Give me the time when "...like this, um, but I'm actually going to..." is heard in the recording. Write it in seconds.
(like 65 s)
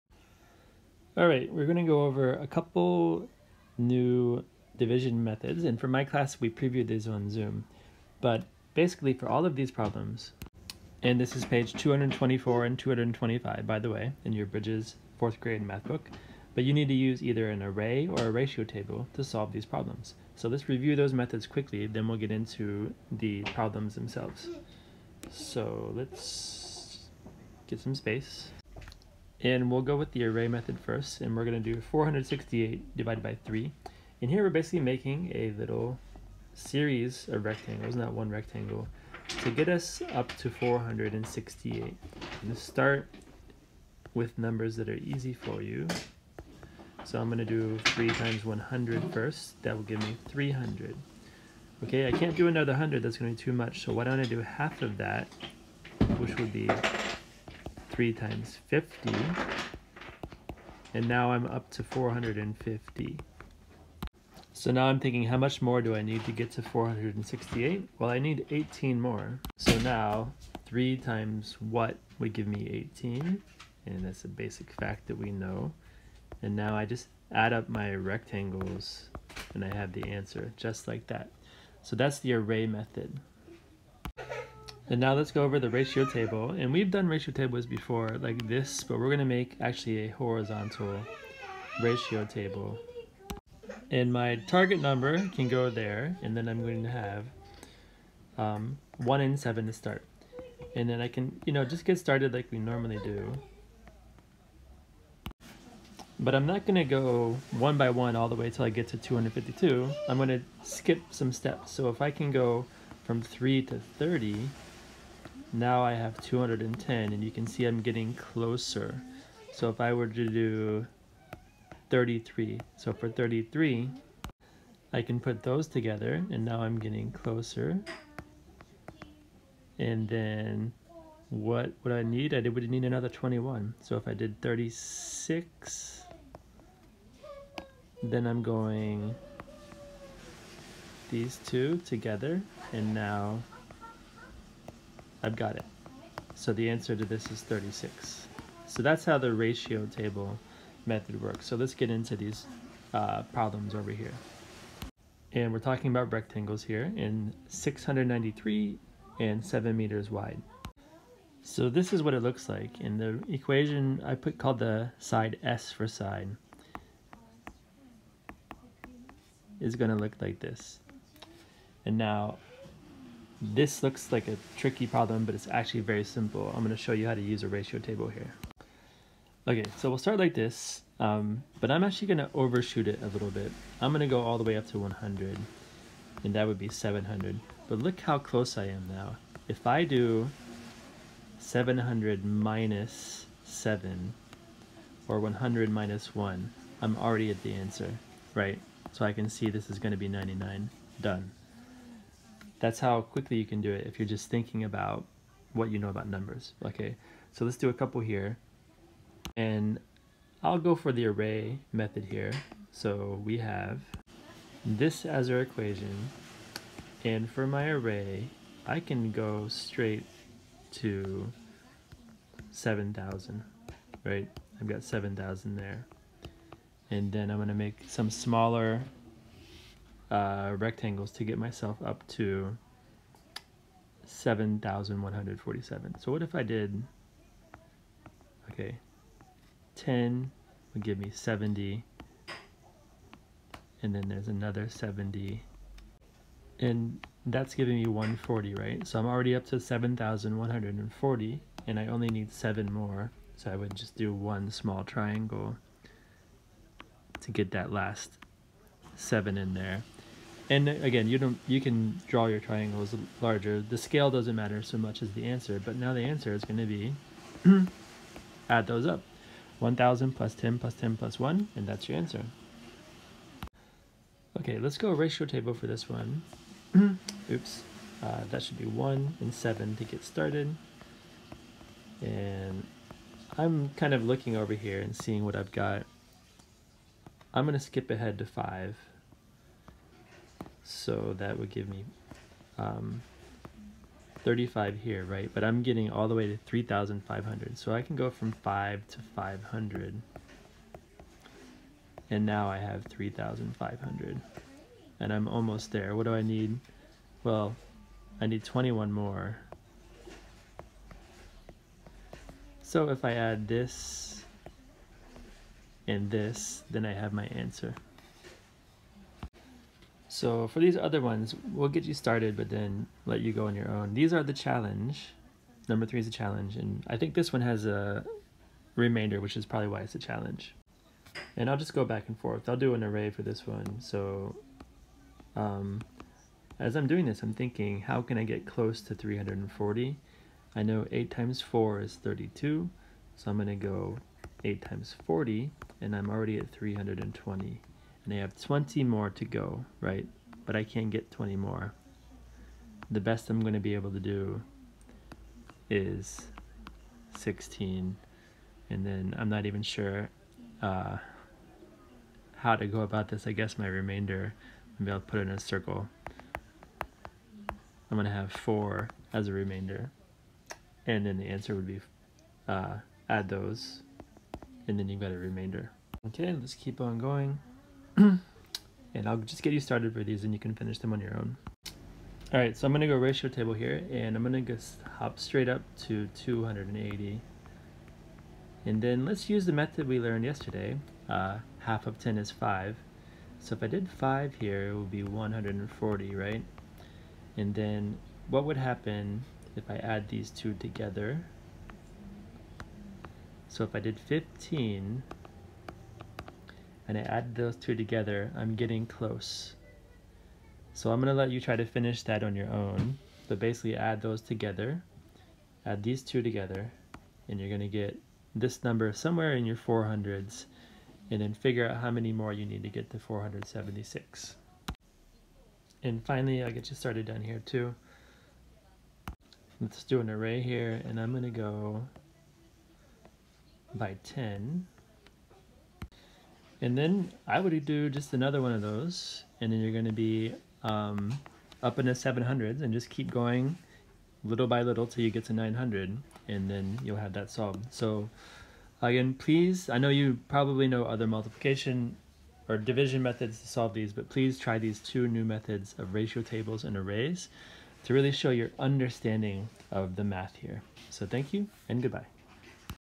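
180 s.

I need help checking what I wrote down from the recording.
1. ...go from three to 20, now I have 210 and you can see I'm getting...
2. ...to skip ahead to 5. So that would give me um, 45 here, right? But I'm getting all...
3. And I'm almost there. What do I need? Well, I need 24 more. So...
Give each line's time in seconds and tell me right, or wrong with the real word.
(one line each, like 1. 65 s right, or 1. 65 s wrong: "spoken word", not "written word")
1. 112 s wrong: "30", not "20"
2. 287 s wrong: "35", not "45"
3. 304 s wrong: "21", not "24".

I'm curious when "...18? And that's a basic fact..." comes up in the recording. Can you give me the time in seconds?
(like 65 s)
72 s.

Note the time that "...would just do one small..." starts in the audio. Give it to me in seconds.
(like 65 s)
253 s.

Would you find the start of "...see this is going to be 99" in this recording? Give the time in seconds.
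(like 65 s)
199 s.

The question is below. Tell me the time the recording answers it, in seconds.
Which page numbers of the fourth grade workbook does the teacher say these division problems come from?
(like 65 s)
11 s.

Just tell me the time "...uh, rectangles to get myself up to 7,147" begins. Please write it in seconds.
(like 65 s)
230 s.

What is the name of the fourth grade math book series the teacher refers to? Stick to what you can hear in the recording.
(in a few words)
Bridges.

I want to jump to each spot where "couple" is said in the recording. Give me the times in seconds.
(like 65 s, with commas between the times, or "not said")
2 s, 207 s.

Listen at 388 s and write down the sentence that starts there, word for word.
And then let's use the method we learned yesterday.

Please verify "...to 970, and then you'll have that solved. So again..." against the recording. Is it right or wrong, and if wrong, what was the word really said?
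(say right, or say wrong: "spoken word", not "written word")
wrong: "900", not "970".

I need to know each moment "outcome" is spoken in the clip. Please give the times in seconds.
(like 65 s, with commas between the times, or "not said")
not said.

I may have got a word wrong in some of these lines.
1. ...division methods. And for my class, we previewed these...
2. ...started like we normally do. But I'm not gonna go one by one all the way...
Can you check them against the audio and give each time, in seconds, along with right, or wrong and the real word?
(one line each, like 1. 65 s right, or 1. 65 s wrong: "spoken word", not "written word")
1. 4 s right
2. 101 s right.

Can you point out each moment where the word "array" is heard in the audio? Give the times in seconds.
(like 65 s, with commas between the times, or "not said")
17 s, 30 s, 82 s, 211 s, 217 s, 332 s, 430 s, 456 s.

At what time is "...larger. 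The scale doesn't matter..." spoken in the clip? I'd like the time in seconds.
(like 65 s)
263 s.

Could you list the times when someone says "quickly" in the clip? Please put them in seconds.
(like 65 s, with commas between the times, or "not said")
21 s, 203 s.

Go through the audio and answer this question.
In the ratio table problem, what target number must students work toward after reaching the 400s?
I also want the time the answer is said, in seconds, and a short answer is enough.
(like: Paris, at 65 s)
476, at 422 s.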